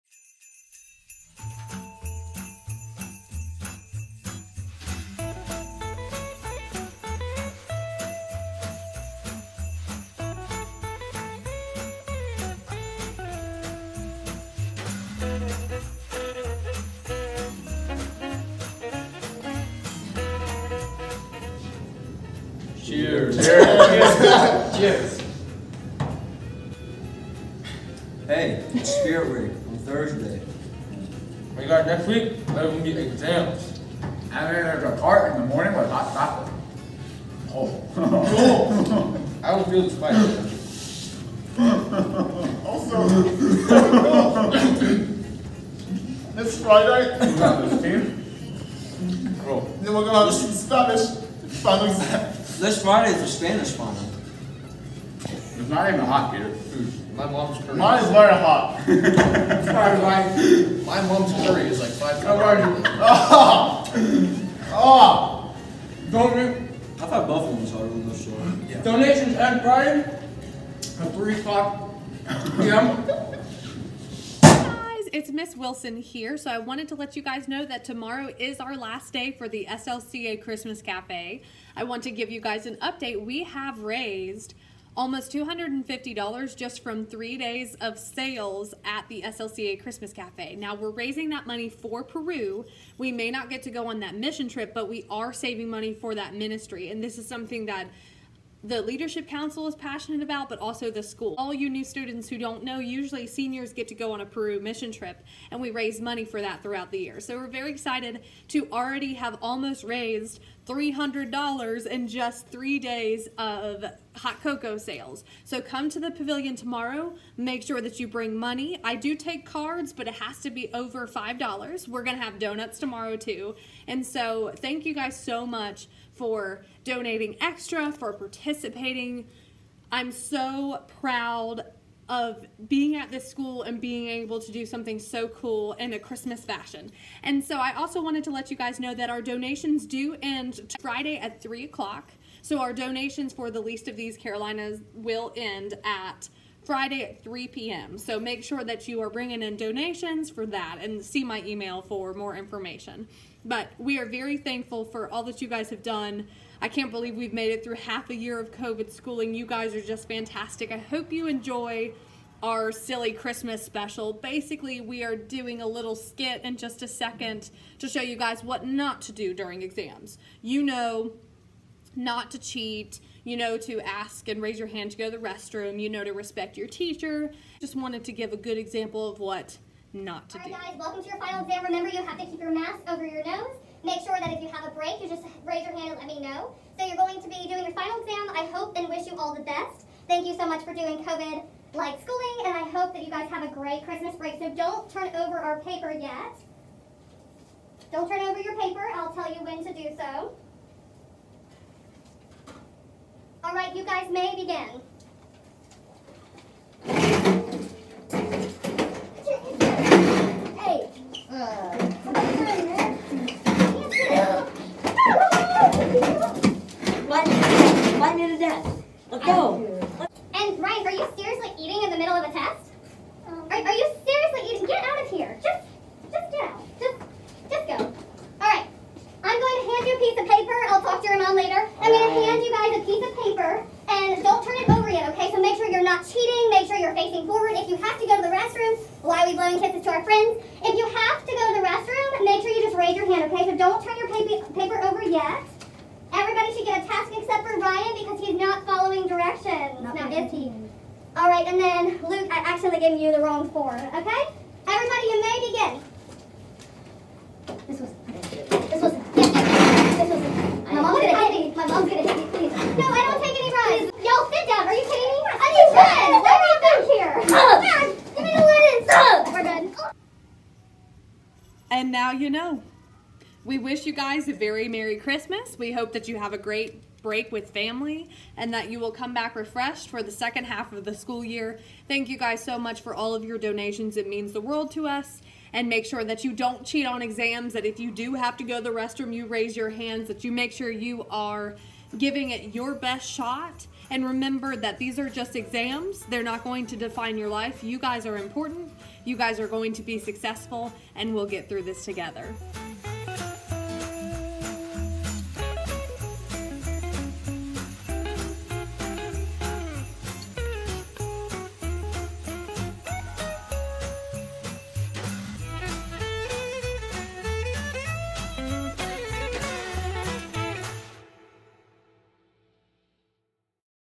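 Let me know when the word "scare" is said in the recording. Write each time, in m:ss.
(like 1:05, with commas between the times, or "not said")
not said.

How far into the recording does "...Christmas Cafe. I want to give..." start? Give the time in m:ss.
1:20.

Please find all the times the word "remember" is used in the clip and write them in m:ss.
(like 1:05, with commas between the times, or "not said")
3:01, 4:54.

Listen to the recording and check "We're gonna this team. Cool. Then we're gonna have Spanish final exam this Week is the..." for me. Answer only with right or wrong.
wrong.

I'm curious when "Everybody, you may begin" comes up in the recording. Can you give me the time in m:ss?
4:14.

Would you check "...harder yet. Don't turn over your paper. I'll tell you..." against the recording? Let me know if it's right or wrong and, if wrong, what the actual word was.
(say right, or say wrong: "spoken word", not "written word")
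wrong: "paper", not "harder".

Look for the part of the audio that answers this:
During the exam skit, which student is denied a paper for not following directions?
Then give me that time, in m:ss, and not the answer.
4:07.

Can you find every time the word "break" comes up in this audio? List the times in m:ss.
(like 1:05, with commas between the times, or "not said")
3:04, 3:14, 4:37.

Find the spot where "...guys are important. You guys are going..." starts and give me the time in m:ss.
4:57.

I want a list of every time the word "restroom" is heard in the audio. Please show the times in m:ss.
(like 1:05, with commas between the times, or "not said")
2:55, 4:01, 4:48.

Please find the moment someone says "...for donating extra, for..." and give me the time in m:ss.
2:06.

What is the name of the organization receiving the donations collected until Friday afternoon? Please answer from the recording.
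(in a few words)
the least of these Carolinas.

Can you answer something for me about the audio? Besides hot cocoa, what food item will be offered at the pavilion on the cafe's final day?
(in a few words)
donuts.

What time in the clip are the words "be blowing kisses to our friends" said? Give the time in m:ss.
3:59.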